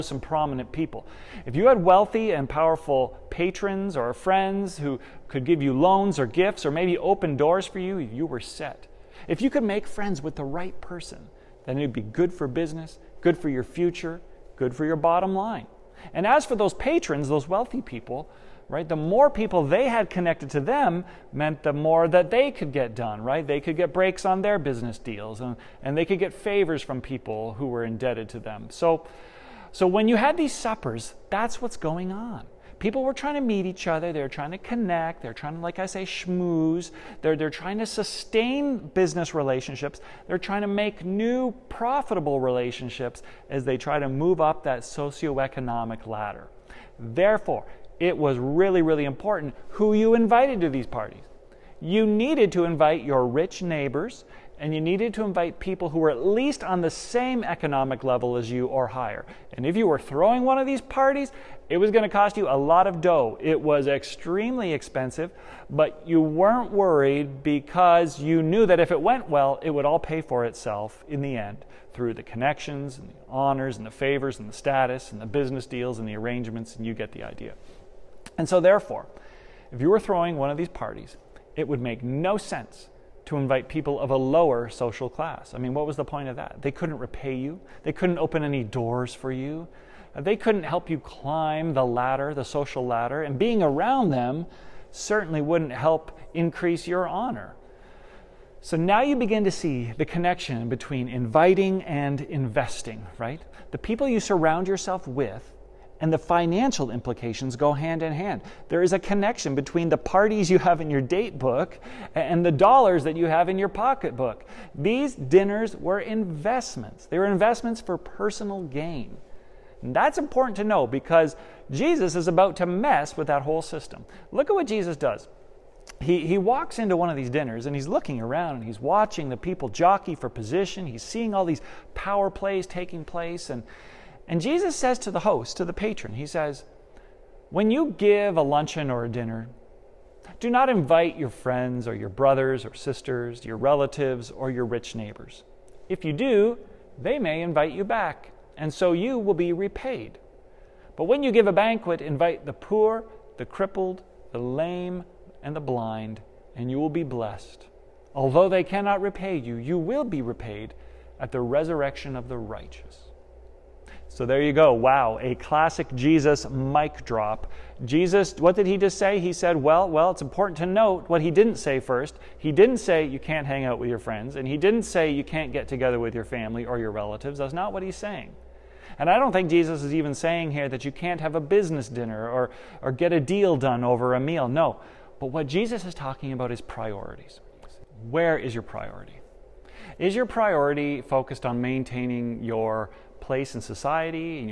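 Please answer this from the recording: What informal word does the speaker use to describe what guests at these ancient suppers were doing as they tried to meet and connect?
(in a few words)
schmooze.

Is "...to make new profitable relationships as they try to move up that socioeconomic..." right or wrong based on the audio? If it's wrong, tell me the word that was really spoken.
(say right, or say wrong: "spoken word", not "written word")
right.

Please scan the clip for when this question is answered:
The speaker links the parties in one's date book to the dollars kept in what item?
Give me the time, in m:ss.
1:53.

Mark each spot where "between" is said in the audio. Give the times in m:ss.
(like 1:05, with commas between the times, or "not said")
1:40, 1:49.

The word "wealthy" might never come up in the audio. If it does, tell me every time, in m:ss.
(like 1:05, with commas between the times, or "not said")
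0:01, 0:17.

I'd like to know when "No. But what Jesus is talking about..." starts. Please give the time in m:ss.
3:04.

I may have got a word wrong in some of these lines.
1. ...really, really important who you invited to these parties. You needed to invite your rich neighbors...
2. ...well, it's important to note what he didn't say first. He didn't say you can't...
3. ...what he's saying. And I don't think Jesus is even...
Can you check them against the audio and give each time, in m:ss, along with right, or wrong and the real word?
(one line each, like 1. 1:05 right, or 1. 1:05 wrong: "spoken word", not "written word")
1. 0:48 right
2. 2:49 right
3. 2:57 right.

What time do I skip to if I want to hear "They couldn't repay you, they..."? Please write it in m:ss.
1:26.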